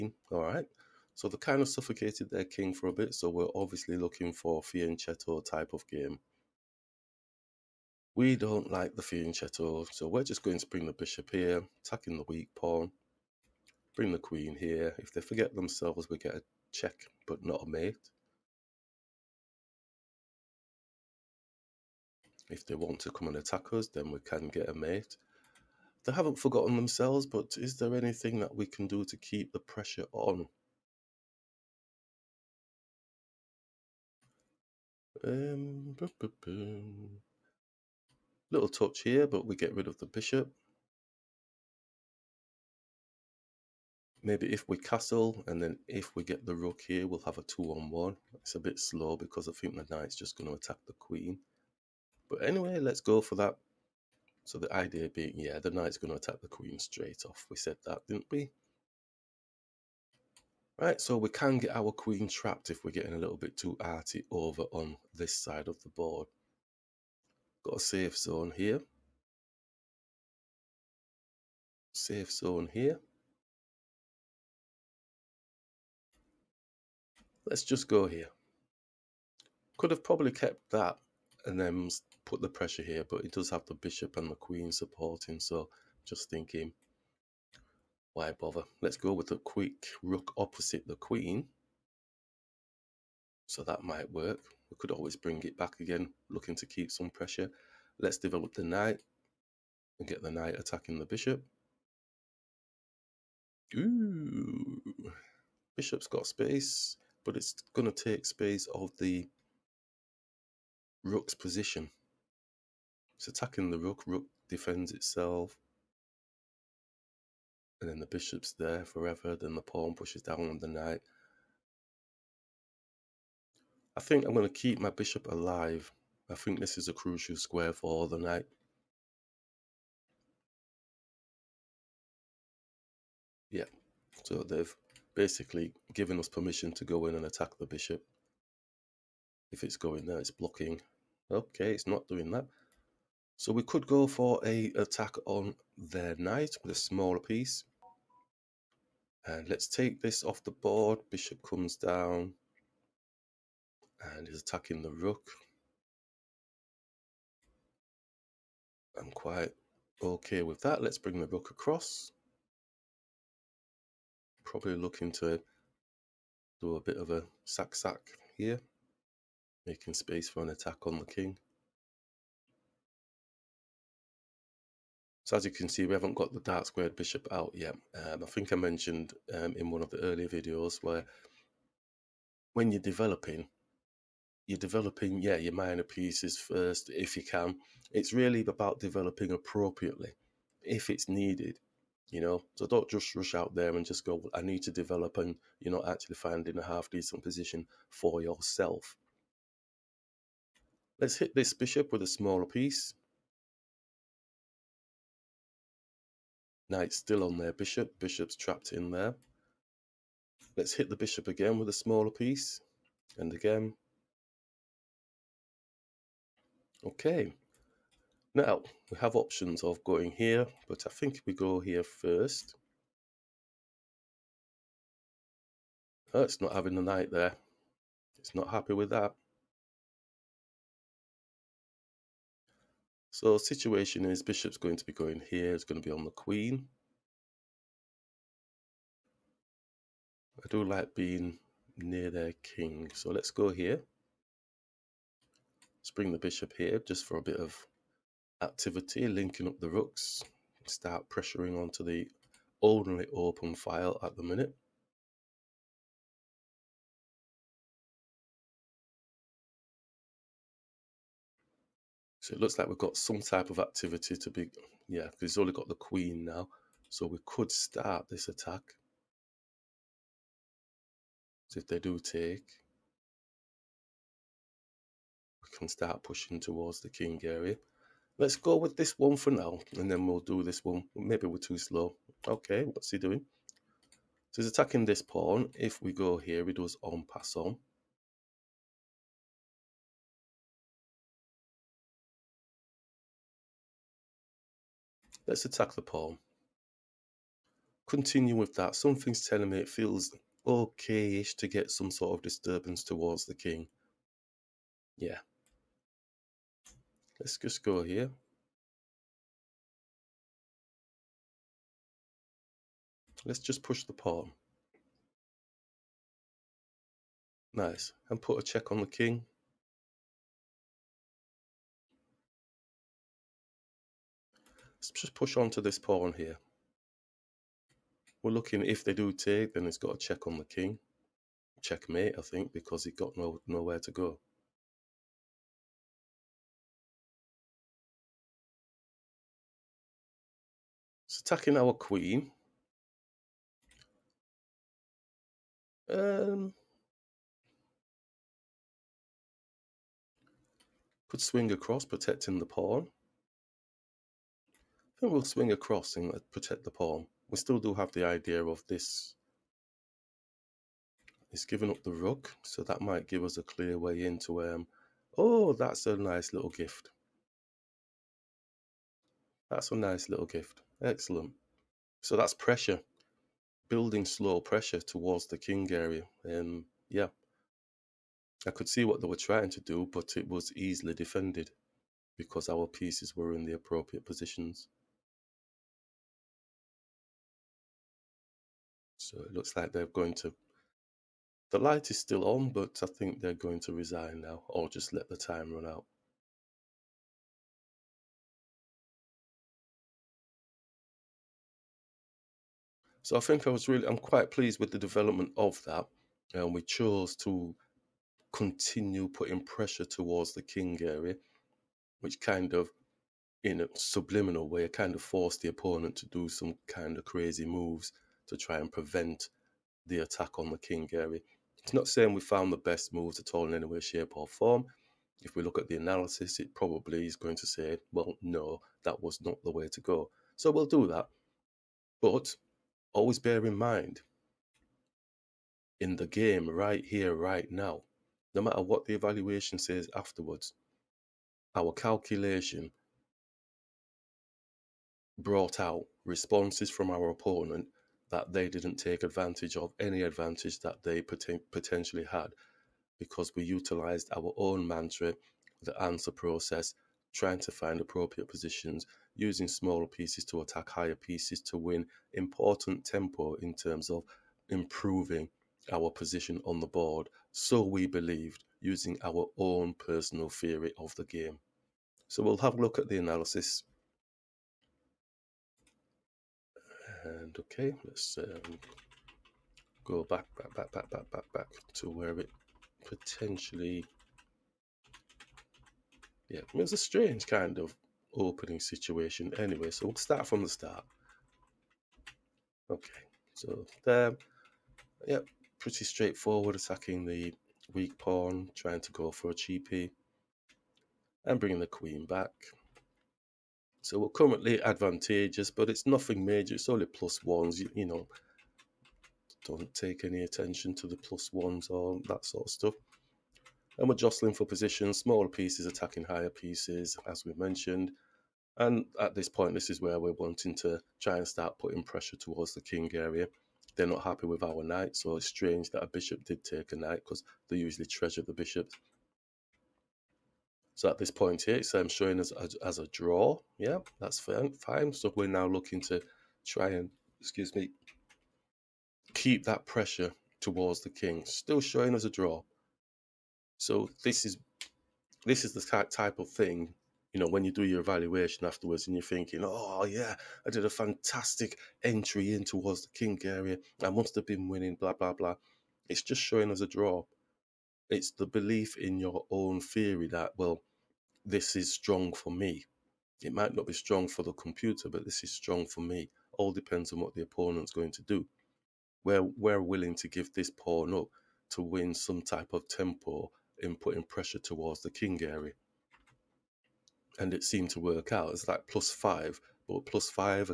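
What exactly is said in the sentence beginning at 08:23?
So we're currently advantageous, but it's nothing major.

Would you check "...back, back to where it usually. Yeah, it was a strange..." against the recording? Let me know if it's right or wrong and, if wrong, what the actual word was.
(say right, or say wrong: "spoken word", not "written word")
wrong: "potentially", not "usually".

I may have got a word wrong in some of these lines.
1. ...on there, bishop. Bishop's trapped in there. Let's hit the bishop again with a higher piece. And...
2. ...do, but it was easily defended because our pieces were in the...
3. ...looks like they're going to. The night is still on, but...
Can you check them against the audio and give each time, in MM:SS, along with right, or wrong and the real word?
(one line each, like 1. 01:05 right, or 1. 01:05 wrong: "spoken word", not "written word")
1. 03:27 wrong: "smaller", not "higher"
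2. 06:19 right
3. 06:29 wrong: "light", not "night".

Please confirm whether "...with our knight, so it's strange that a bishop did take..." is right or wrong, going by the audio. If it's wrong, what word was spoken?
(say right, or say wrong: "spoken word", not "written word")
right.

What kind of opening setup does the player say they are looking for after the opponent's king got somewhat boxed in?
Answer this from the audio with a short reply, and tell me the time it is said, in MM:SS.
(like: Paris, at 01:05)
Fianchetto, at 00:04.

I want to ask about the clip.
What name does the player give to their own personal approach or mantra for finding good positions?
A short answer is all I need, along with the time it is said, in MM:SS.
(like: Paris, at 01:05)
The answer process, at 07:35.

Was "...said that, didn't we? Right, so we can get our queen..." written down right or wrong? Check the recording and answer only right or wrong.
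right.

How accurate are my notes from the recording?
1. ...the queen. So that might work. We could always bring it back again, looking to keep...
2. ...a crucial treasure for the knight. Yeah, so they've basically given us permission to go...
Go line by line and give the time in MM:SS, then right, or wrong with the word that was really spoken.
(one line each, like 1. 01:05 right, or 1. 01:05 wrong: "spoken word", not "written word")
1. 01:30 right
2. 02:06 wrong: "square", not "treasure".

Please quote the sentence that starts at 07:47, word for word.
So we believed using our own personal theory of the game.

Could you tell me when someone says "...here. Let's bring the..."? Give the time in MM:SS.
04:03.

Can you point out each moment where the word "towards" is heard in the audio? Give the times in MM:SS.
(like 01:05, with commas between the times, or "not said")
04:36, 05:02, 06:14, 06:49, 08:42, 09:00, 09:12, 09:34.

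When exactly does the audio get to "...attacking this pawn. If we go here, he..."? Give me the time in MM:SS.
04:44.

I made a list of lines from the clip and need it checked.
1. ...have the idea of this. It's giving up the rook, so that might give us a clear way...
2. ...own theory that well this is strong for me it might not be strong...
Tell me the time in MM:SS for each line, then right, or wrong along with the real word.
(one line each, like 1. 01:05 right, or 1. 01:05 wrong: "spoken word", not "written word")
1. 05:57 right
2. 09:19 right.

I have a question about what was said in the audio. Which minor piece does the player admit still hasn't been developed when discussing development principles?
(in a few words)
Dark squared bishop.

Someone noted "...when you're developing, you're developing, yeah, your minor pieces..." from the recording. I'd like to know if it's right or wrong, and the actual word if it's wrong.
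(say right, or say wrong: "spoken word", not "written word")
right.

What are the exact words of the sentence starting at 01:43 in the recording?
Ooh, bishop's got space, but it's going to take space of the rook's position.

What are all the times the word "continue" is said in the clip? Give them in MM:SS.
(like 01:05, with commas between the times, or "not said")
04:57, 06:48.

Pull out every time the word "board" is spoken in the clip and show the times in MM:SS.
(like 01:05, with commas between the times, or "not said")
01:05, 02:30, 07:46.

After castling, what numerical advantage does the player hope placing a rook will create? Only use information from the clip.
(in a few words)
2-on-1.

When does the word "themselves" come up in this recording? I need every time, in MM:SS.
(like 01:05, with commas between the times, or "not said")
00:15, 00:26.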